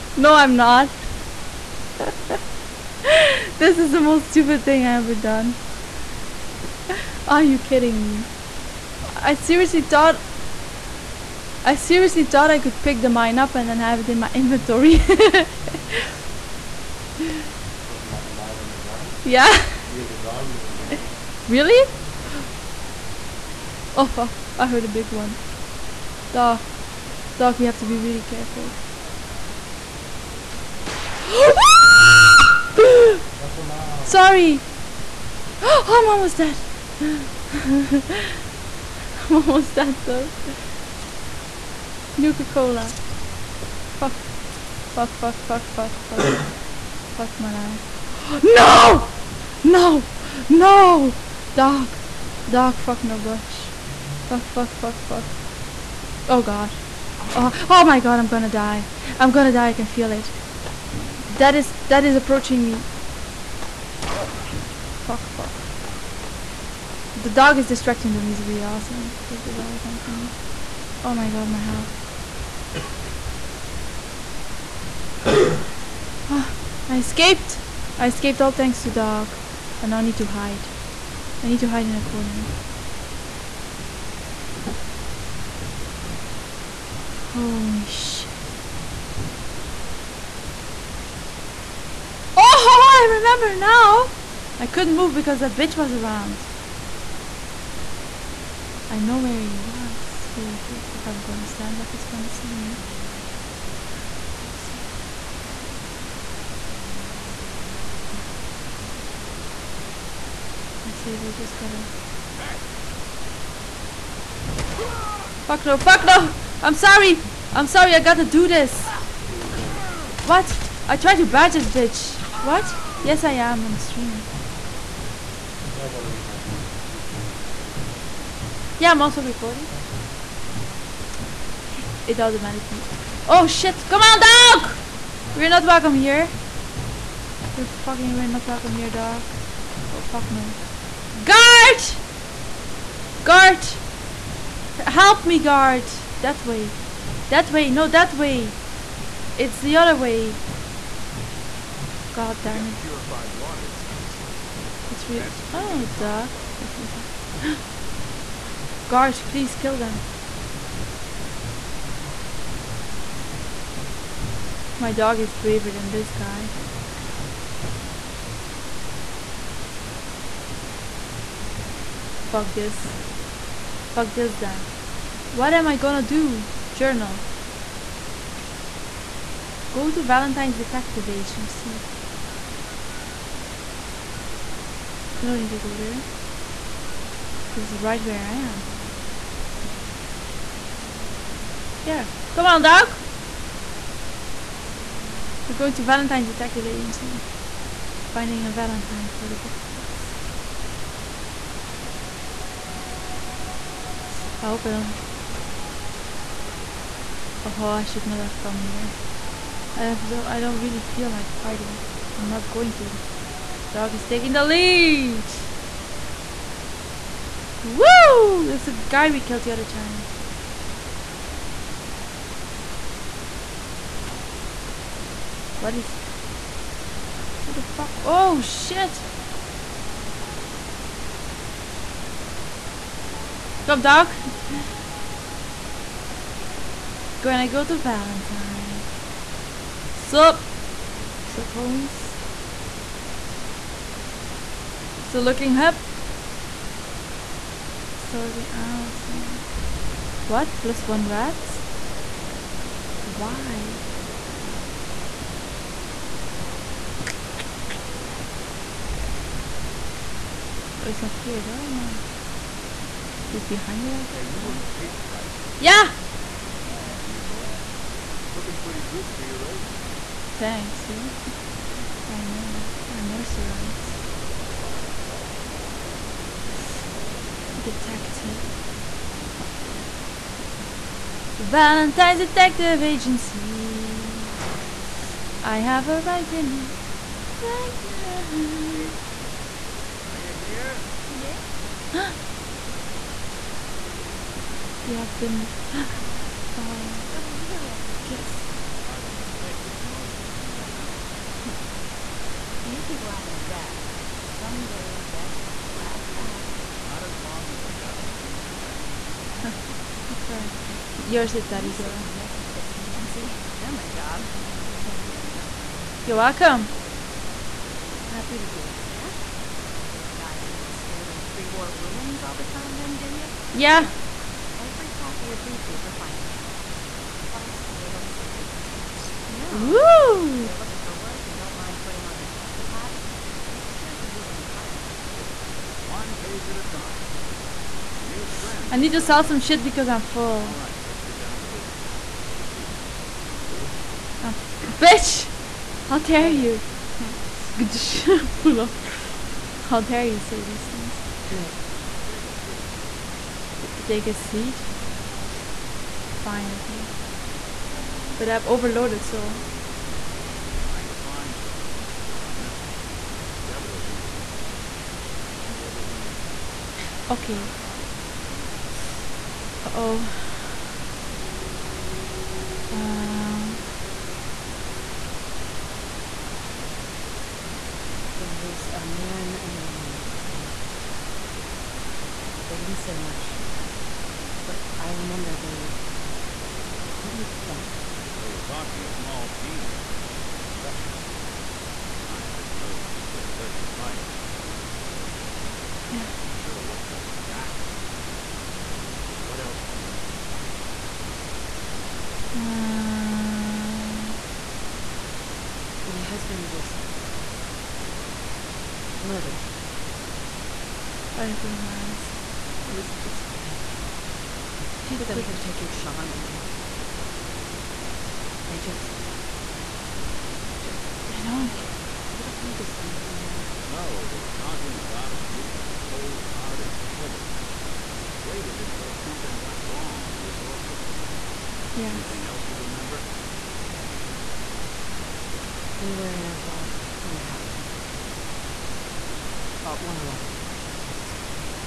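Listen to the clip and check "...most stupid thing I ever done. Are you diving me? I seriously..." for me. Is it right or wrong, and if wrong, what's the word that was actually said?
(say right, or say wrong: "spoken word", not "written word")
wrong: "kidding", not "diving".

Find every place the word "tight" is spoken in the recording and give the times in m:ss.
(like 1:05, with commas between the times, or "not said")
6:33.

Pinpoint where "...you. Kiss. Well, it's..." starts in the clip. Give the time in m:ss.
4:57.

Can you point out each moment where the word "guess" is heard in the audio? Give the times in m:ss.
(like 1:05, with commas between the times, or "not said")
4:24.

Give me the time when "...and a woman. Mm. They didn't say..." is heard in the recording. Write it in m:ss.
6:19.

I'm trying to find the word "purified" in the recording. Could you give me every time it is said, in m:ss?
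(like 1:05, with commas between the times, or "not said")
2:32.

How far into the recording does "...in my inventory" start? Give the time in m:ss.
0:14.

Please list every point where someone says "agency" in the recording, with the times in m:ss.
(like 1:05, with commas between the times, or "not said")
3:01, 3:16, 4:42, 5:12.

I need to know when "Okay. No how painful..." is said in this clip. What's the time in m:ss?
6:07.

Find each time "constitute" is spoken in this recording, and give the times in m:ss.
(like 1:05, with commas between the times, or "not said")
not said.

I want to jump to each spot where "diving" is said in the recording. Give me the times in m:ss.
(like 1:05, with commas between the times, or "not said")
5:20.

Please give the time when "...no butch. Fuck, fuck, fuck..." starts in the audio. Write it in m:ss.
0:53.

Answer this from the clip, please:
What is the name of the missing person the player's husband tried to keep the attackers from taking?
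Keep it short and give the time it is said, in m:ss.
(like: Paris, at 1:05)
Sean, at 6:55.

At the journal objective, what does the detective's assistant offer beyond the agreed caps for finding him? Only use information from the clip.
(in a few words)
a little something extra.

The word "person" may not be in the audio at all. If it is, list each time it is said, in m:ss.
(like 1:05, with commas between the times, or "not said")
not said.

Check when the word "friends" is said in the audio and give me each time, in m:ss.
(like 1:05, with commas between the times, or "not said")
5:08, 5:38.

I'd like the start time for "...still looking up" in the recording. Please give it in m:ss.
4:05.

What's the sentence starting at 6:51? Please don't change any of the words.
Right in front of my eyes.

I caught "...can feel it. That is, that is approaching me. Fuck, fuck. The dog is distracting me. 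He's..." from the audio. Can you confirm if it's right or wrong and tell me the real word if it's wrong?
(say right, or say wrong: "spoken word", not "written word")
right.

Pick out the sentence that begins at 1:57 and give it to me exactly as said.
I'm sorry, I gotta do this!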